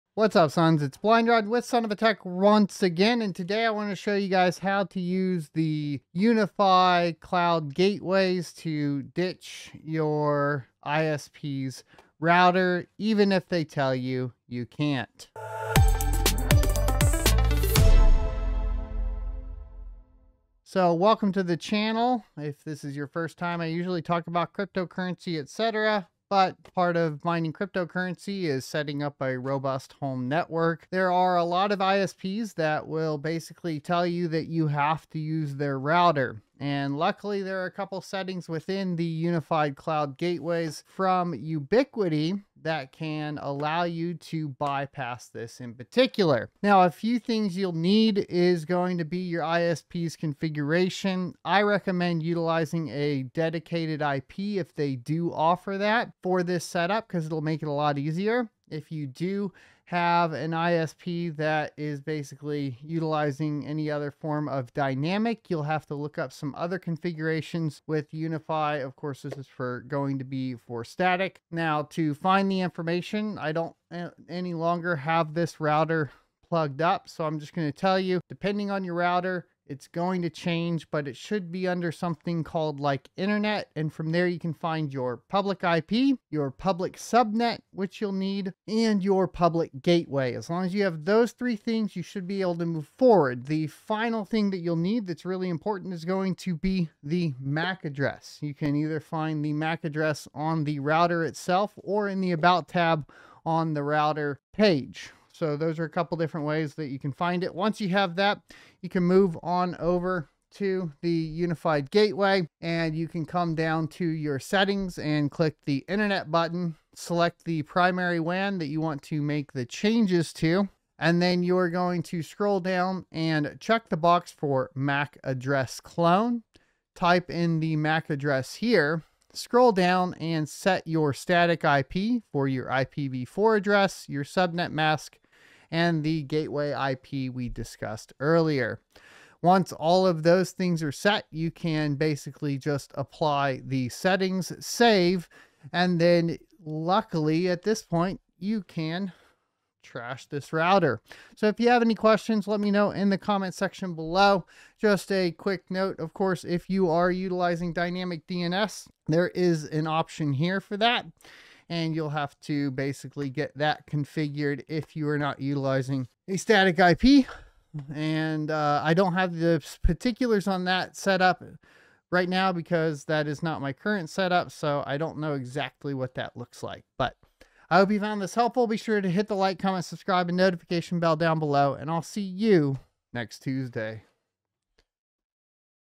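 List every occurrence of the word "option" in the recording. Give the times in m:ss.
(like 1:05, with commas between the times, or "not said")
2:39.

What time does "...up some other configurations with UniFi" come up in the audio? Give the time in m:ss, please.
1:06.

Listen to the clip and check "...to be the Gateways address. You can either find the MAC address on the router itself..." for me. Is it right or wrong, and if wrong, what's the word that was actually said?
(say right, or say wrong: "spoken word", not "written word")
wrong: "MAC", not "Gateways".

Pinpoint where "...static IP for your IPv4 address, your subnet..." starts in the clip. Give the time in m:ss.
2:11.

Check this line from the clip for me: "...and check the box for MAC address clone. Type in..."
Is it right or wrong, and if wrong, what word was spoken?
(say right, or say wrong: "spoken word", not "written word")
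right.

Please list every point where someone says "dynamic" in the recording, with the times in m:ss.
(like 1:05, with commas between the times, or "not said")
1:04, 2:37.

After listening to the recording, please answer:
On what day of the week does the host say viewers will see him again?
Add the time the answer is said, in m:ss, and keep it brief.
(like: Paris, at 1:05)
Tuesday, at 3:03.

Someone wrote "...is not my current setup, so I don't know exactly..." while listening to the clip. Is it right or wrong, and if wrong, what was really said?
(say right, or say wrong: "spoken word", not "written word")
right.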